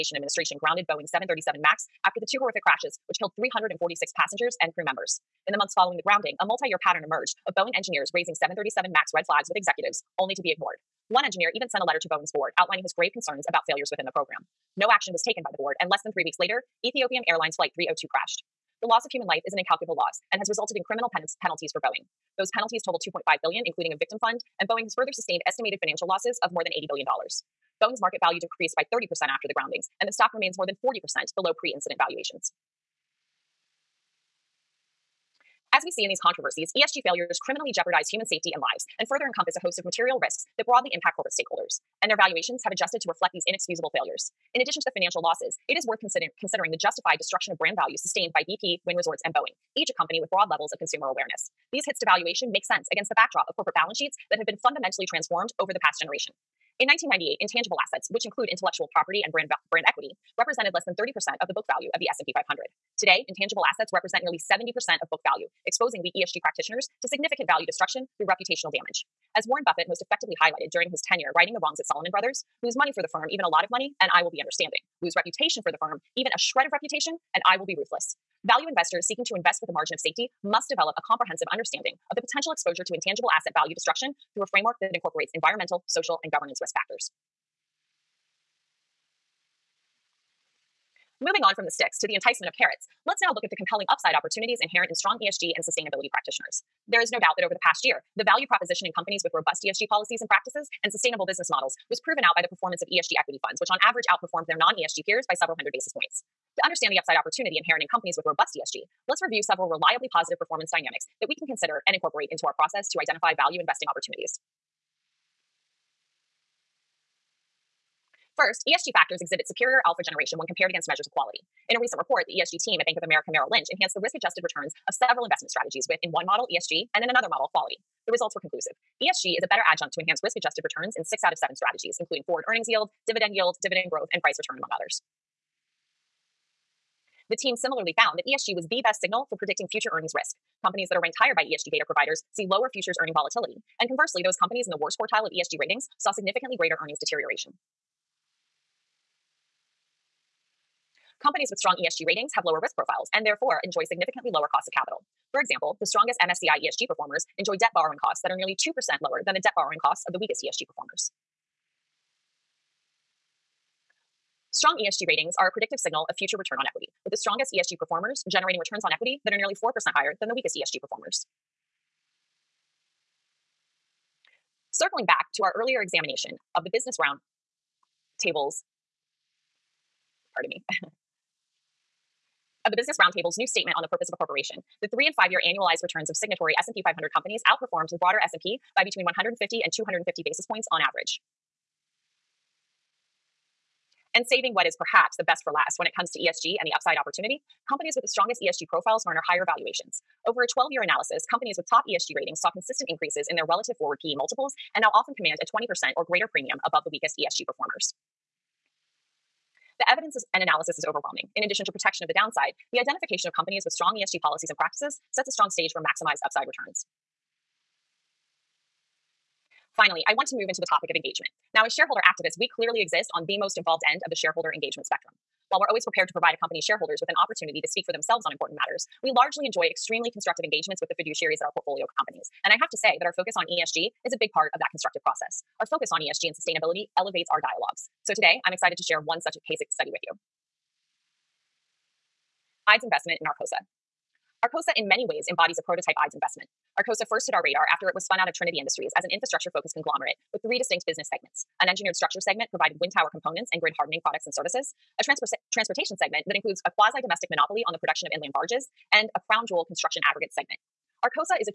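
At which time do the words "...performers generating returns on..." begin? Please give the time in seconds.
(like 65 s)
167 s.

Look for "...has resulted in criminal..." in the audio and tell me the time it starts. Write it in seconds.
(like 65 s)
20 s.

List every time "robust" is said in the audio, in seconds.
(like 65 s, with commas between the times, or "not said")
99 s, 108 s.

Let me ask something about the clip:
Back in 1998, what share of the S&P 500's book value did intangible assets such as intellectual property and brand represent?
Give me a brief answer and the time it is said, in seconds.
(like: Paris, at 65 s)
less than 30%, at 60 s.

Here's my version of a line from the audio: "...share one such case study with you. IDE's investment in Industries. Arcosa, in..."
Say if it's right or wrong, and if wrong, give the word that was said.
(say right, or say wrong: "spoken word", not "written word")
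wrong: "Arcosa", not "Industries".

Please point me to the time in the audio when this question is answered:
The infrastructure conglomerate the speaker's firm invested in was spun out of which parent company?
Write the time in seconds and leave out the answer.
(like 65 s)
248 s.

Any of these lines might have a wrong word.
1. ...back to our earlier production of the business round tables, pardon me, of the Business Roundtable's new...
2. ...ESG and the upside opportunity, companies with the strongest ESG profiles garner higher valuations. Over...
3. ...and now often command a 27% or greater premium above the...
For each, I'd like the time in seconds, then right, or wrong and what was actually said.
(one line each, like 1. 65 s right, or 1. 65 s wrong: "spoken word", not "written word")
1. 175 s wrong: "examination", not "production"
2. 196 s right
3. 204 s wrong: "20", not "27".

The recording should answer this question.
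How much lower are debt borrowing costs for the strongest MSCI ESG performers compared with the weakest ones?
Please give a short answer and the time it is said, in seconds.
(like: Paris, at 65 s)
nearly 2%, at 158 s.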